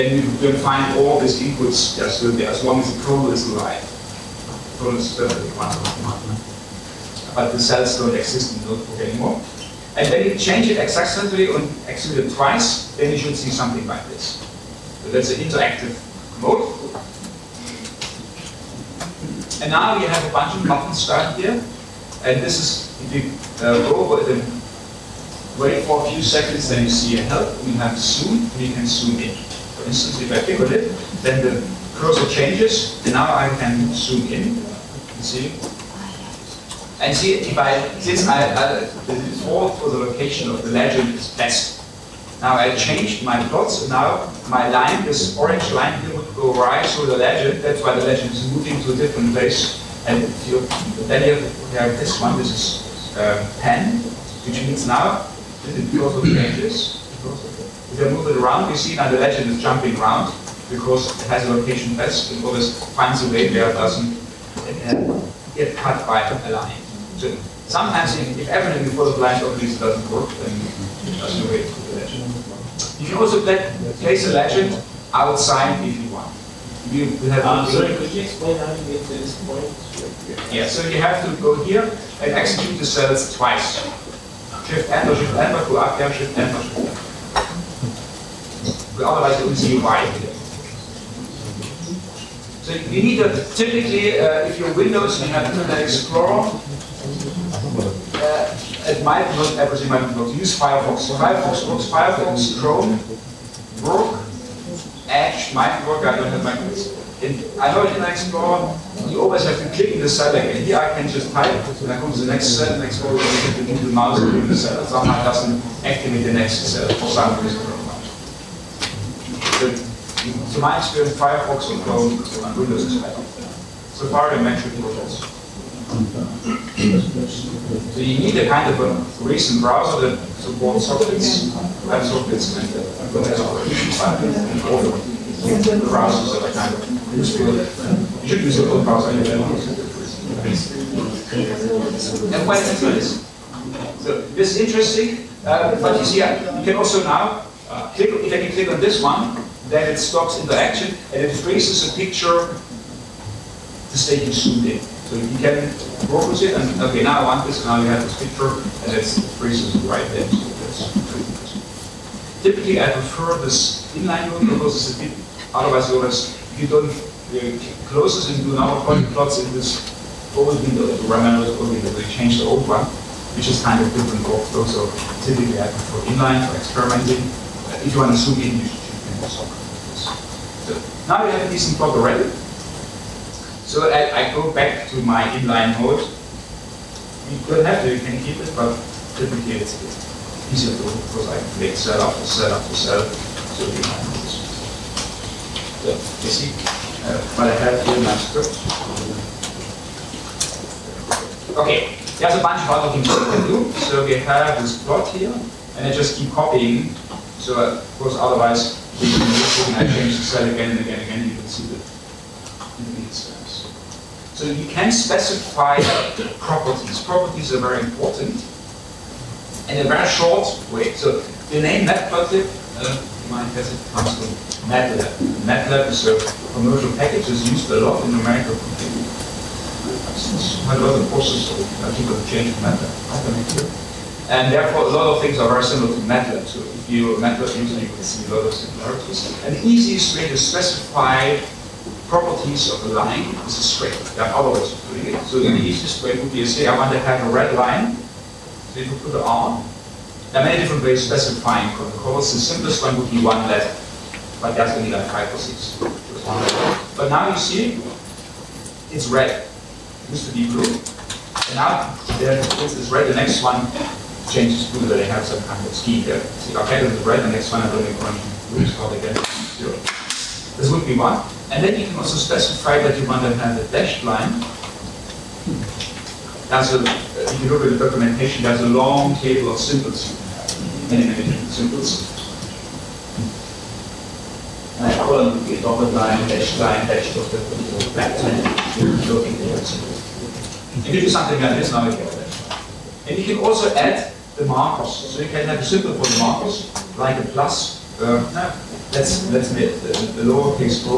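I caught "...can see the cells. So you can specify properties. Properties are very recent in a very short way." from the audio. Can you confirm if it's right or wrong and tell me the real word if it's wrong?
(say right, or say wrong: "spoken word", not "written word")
wrong: "important", not "recent".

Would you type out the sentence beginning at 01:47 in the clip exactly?
I know Internet Explorer you always have to click in the cell again.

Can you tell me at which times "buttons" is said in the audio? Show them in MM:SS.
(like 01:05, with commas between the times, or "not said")
00:20.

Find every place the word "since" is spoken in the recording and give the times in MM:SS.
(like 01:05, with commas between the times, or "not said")
00:37, 03:50.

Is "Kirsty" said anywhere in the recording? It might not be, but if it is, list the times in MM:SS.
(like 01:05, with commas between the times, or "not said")
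not said.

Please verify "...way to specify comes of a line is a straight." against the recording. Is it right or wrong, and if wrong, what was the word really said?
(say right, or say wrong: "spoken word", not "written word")
wrong: "properties", not "comes".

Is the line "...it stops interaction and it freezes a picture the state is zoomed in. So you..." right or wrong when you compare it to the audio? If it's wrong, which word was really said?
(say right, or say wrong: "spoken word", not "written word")
right.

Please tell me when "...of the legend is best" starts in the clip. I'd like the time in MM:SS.
00:40.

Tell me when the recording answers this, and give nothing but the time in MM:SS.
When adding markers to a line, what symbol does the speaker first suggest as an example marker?
04:57.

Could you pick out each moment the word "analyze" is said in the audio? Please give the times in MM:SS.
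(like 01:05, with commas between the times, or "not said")
01:29.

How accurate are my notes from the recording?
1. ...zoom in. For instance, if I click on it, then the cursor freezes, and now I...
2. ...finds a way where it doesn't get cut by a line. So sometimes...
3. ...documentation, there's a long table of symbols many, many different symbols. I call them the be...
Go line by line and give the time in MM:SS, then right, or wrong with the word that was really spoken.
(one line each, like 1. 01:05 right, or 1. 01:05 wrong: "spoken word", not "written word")
1. 00:28 wrong: "changes", not "freezes"
2. 01:02 right
3. 04:37 right.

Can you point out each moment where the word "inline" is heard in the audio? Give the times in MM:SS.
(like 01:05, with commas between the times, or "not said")
02:43, 02:56, 03:05.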